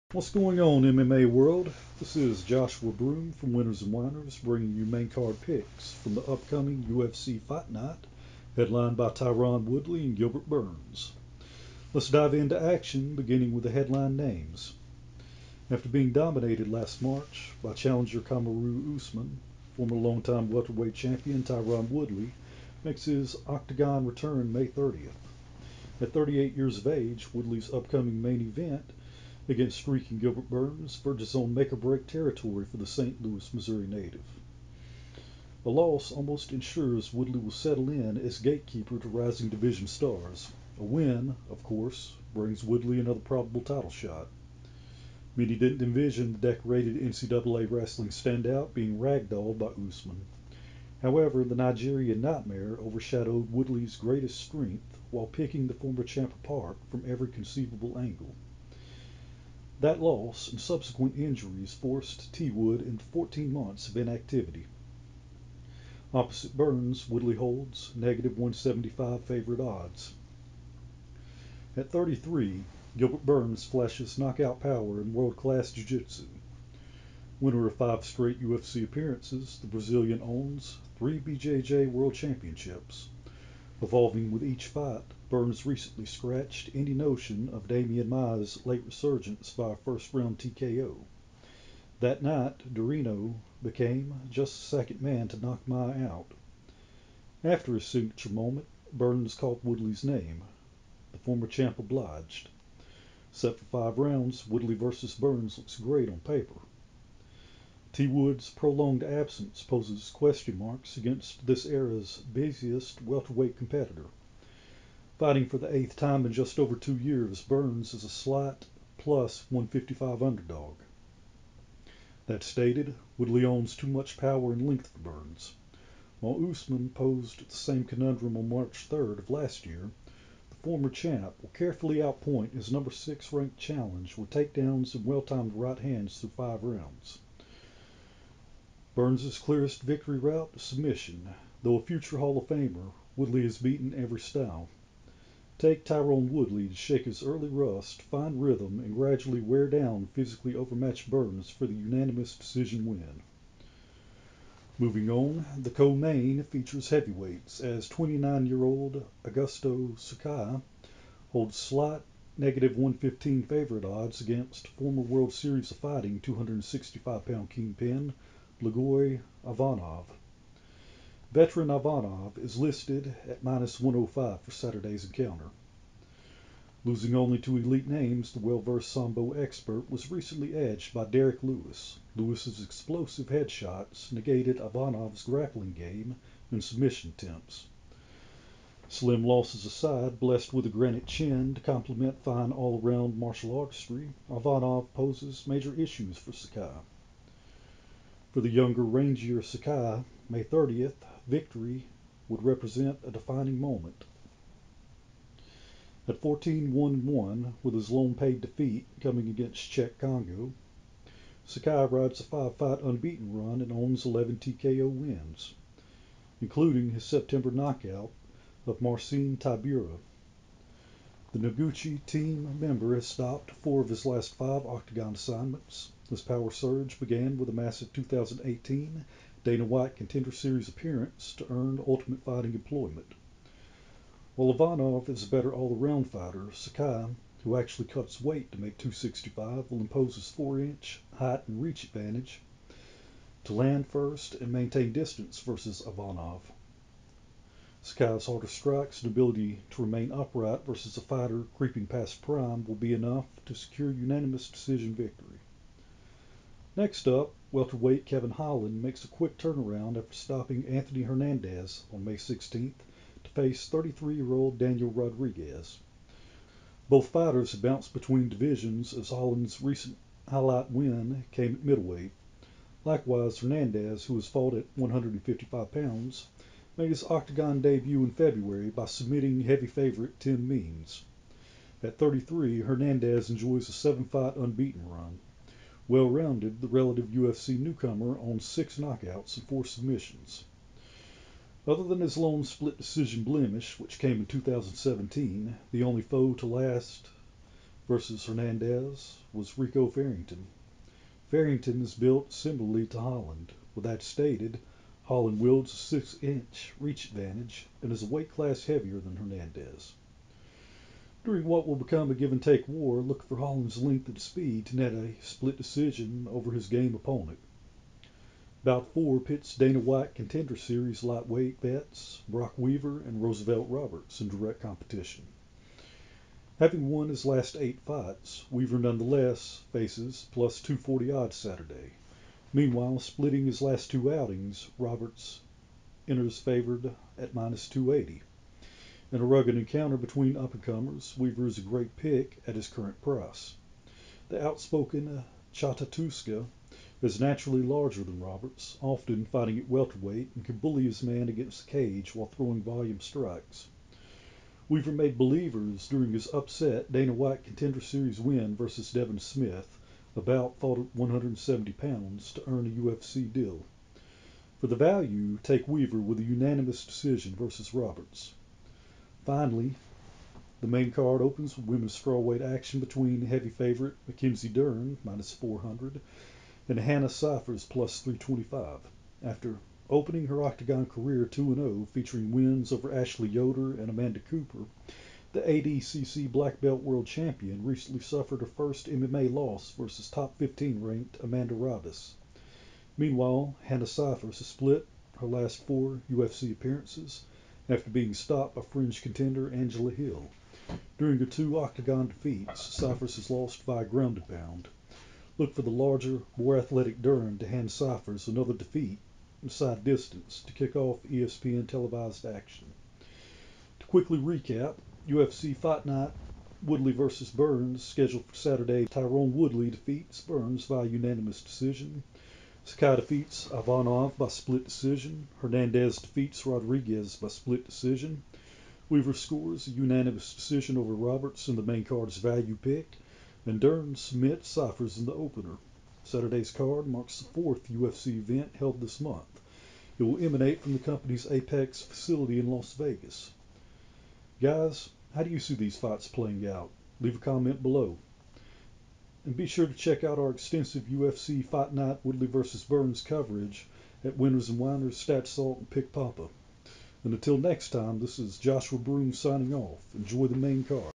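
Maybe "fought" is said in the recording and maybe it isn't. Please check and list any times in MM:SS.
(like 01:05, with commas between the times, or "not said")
04:34, 06:00.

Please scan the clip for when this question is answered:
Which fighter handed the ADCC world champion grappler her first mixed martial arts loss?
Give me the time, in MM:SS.
06:31.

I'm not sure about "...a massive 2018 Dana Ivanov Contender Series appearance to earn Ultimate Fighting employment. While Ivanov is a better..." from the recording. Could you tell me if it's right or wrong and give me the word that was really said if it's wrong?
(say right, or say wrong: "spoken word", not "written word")
wrong: "White", not "Ivanov".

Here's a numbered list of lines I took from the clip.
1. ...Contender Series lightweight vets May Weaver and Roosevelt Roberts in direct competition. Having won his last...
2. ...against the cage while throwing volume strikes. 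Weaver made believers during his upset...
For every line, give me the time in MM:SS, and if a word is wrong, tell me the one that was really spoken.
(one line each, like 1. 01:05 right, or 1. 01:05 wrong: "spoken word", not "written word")
1. 05:20 wrong: "Brock", not "May"
2. 05:51 right.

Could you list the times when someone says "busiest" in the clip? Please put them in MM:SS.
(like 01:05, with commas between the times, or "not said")
01:52.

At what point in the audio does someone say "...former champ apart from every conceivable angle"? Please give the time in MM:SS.
00:55.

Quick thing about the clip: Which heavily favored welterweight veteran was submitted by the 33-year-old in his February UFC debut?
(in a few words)
Tim Means.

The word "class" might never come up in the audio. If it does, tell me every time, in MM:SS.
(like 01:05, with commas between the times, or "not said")
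01:15, 05:08.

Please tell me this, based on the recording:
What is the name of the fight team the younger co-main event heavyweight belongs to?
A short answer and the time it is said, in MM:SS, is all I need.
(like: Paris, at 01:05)
Noguchi, at 03:41.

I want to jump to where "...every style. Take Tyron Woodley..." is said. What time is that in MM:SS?
02:23.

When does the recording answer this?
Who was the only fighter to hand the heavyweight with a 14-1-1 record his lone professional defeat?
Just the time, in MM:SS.
03:29.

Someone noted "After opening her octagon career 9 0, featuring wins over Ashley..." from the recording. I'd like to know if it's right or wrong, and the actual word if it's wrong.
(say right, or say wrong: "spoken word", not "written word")
wrong: "2", not "9".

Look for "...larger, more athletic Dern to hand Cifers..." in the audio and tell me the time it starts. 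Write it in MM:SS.
06:45.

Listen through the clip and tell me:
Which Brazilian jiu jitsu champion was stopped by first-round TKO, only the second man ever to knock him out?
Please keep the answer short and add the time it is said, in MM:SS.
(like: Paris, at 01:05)
Demian Maia, at 01:27.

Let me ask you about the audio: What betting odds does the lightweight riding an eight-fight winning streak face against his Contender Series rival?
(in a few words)
+240.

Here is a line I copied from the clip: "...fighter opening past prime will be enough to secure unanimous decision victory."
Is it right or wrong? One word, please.
wrong.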